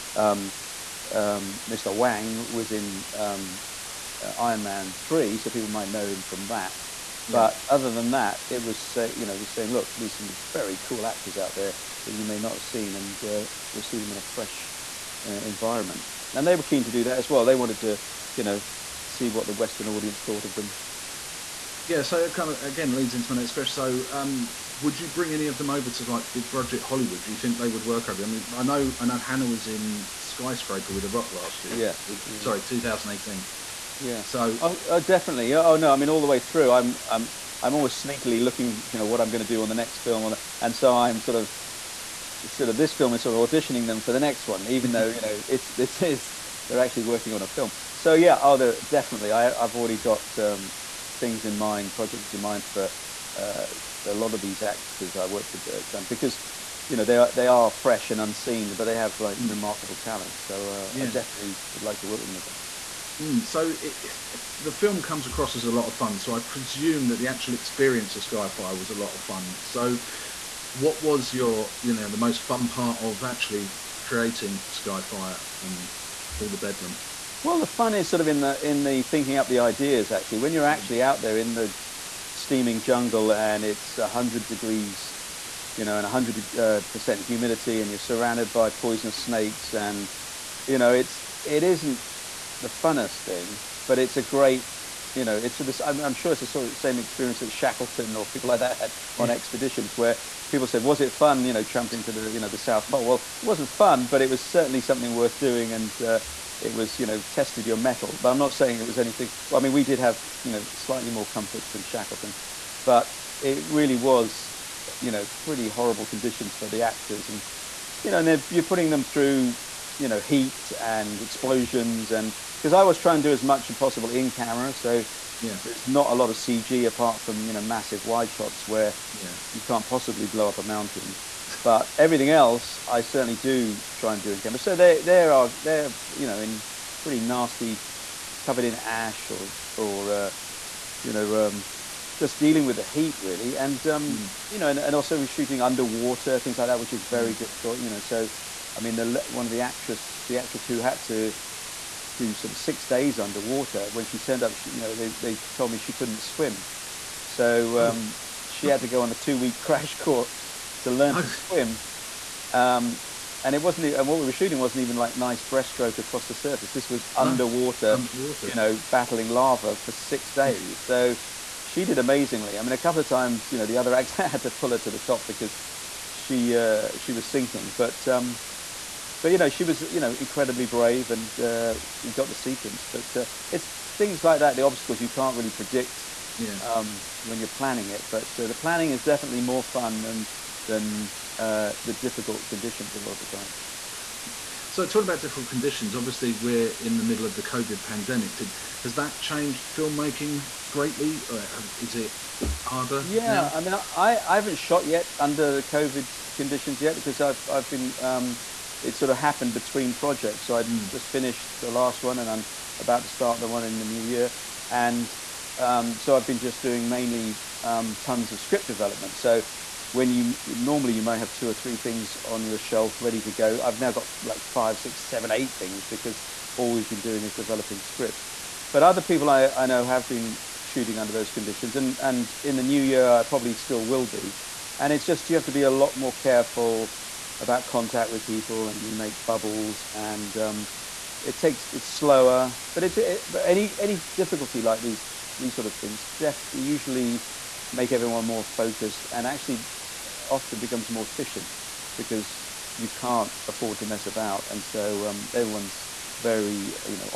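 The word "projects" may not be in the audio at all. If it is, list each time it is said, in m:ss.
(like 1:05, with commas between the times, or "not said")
0:51, 3:29.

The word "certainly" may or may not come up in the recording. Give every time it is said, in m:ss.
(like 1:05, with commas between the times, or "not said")
1:44, 2:13.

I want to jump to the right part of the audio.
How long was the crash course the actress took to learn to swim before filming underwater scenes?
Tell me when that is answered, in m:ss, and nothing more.
2:39.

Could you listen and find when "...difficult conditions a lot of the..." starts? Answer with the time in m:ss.
3:11.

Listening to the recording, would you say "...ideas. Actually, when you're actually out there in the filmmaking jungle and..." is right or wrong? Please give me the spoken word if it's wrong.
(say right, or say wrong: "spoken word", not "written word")
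wrong: "steaming", not "filmmaking".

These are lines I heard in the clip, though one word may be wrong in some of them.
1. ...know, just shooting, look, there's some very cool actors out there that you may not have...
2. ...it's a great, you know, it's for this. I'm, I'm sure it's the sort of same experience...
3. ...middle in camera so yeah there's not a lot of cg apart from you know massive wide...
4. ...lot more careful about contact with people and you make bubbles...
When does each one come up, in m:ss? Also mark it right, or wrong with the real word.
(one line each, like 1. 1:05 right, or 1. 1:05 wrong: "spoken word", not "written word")
1. 0:09 wrong: "saying", not "shooting"
2. 1:33 right
3. 2:03 wrong: "possible", not "middle"
4. 3:55 right.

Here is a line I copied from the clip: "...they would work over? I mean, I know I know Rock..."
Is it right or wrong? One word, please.
wrong.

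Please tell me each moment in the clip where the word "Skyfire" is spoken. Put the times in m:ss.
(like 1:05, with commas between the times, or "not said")
1:08, 1:14.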